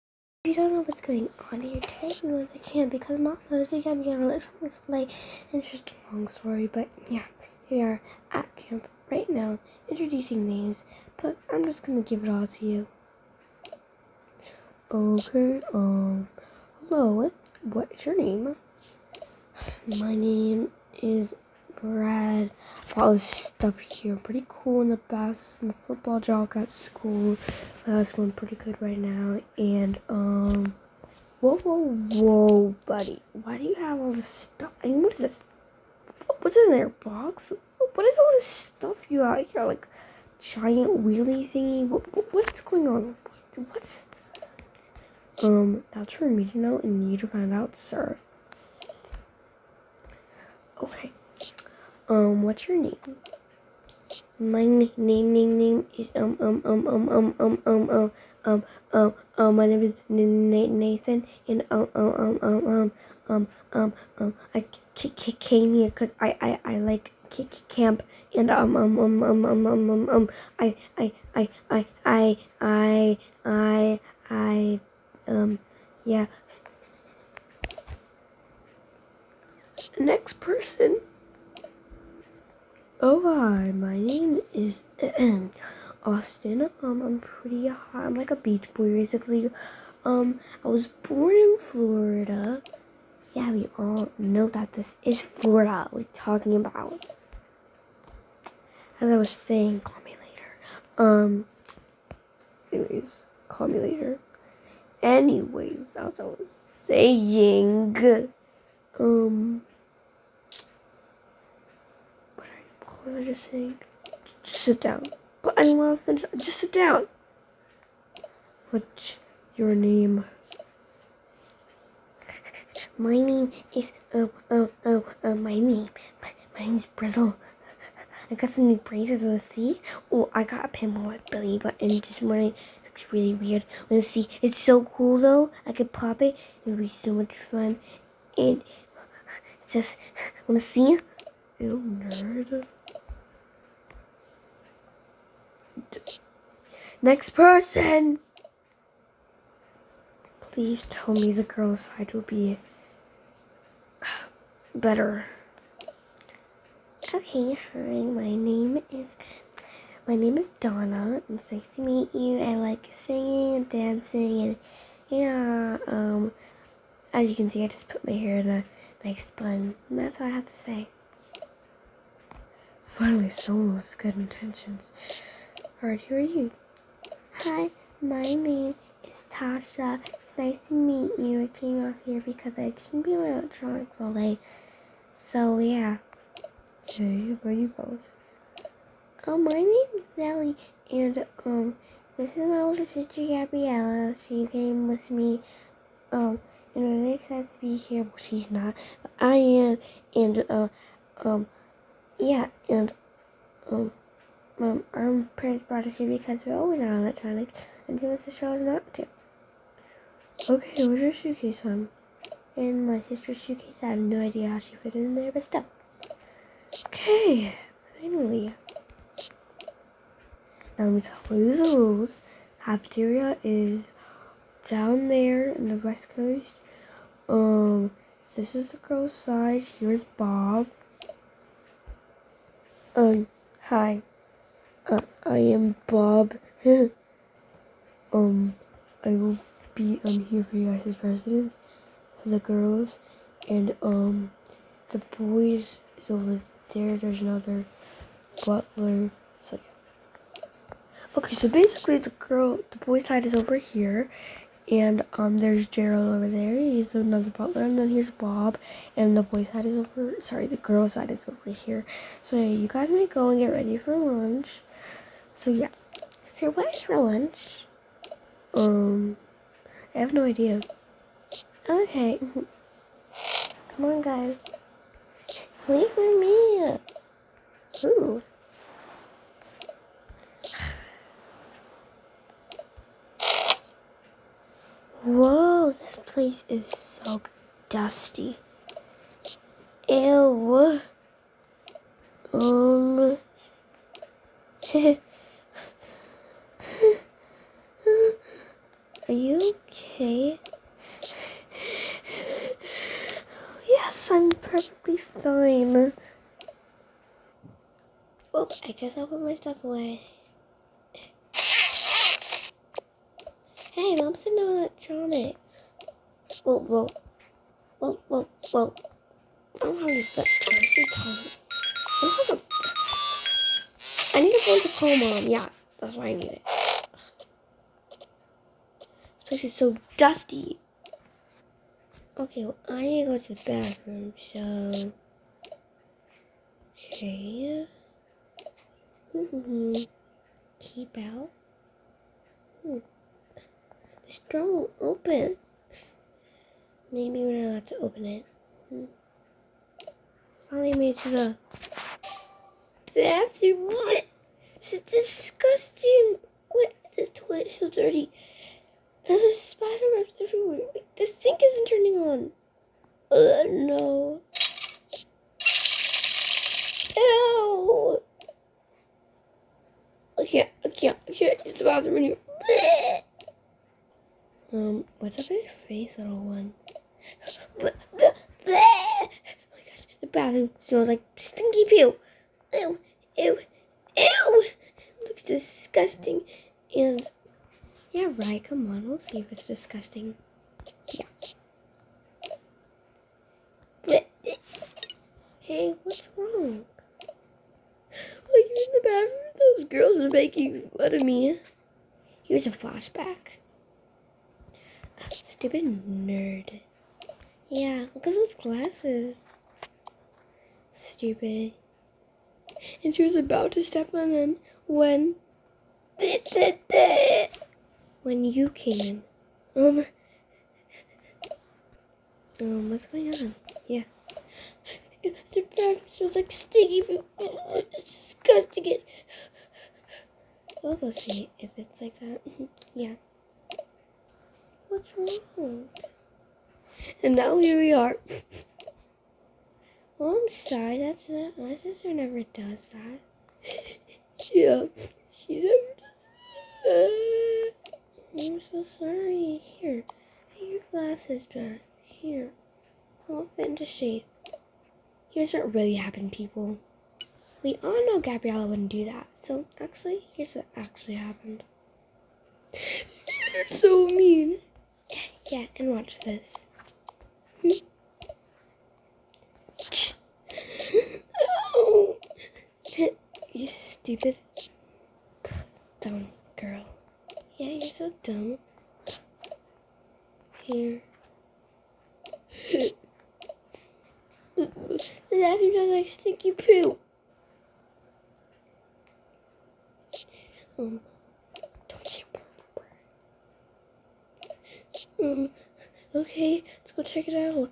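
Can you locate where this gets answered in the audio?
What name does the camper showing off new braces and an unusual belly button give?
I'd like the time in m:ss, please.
2:06.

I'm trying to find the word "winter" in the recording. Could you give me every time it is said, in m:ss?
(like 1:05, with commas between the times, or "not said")
not said.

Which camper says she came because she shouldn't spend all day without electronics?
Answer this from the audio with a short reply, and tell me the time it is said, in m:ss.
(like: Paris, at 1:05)
Tasha, at 2:59.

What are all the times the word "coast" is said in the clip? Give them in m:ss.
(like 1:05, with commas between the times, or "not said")
3:46.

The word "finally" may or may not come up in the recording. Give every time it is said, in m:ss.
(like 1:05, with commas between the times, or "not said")
2:52, 3:37, 5:50.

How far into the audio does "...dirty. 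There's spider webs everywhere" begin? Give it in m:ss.
5:57.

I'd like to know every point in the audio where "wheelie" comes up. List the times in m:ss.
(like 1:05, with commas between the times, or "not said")
0:41.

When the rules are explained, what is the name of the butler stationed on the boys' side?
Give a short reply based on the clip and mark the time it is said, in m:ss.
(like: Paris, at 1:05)
Gerald, at 4:15.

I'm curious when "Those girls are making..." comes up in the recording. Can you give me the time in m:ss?
6:39.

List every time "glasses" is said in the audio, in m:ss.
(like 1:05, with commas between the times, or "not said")
6:48, 7:30.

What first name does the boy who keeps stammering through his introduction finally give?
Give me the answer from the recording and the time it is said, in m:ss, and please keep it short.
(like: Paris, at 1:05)
Nathan, at 0:59.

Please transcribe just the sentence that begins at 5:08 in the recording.
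Well, I guess I'll put my stuff away.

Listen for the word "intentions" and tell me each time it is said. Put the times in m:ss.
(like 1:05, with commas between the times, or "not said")
2:54.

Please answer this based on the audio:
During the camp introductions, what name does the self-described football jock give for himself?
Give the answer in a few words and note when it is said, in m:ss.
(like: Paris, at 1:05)
Bread, at 0:19.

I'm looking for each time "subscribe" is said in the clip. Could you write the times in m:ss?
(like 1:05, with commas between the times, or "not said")
not said.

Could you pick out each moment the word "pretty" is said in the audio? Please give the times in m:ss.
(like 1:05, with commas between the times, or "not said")
0:24, 0:28, 1:27.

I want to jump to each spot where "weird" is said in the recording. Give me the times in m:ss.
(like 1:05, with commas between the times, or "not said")
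2:13.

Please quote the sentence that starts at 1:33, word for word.
Yeah, we all know that this is Florida we're talking about.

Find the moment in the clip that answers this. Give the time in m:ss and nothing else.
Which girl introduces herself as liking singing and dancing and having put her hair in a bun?
2:40.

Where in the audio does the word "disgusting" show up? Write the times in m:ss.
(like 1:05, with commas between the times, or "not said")
5:54, 6:25, 6:29, 7:08.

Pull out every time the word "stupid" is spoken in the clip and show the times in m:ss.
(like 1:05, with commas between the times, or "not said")
6:45, 6:50, 7:53.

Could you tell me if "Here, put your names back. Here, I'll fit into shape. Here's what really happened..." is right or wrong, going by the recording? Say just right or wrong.
wrong.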